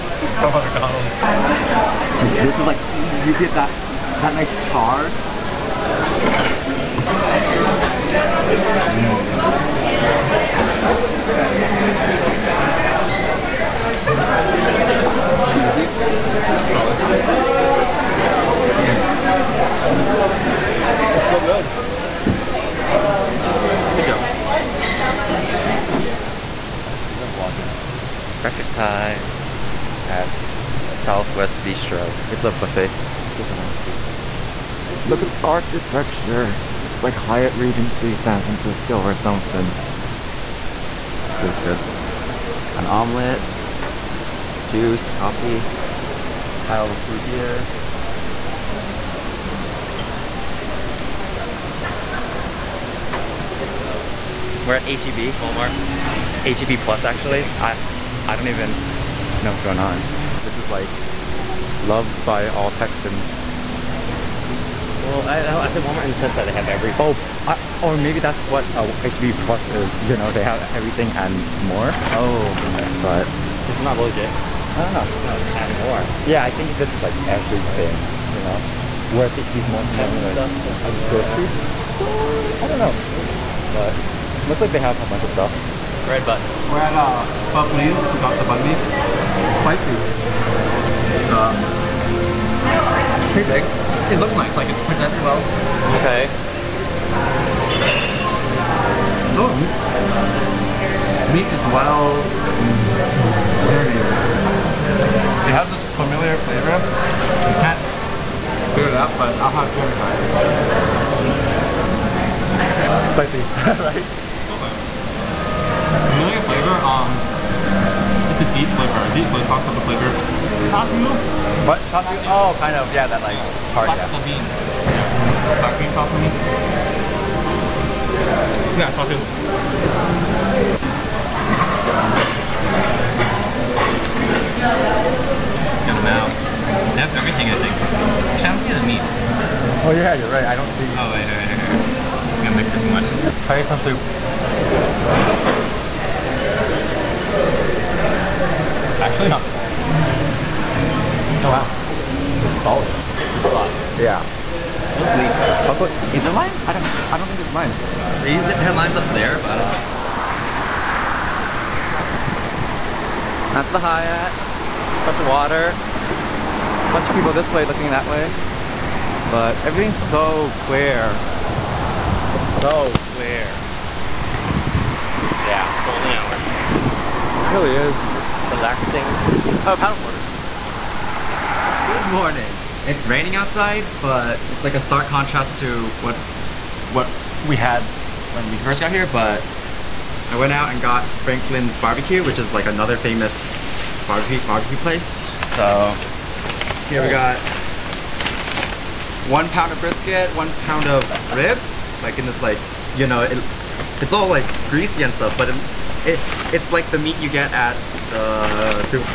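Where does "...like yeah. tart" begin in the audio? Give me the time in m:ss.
2:03.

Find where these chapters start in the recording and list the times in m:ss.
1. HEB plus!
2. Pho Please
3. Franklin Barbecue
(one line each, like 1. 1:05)
1. 0:53
2. 1:25
3. 3:01.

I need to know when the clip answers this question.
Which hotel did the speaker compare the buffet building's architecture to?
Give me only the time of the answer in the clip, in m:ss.
0:37.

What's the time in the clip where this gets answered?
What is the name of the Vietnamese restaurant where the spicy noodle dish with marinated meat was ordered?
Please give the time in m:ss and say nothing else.
1:27.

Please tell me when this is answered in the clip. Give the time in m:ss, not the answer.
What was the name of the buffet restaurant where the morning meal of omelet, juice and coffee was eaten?
0:31.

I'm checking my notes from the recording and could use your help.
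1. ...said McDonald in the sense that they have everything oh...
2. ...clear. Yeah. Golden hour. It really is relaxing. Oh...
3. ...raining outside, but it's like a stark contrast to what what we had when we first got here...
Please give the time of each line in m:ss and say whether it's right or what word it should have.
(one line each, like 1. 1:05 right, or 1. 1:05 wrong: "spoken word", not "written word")
1. 1:05 wrong: "Walmart", not "McDonald"
2. 2:53 right
3. 3:03 right.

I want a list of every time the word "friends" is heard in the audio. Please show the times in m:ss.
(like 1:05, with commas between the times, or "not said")
not said.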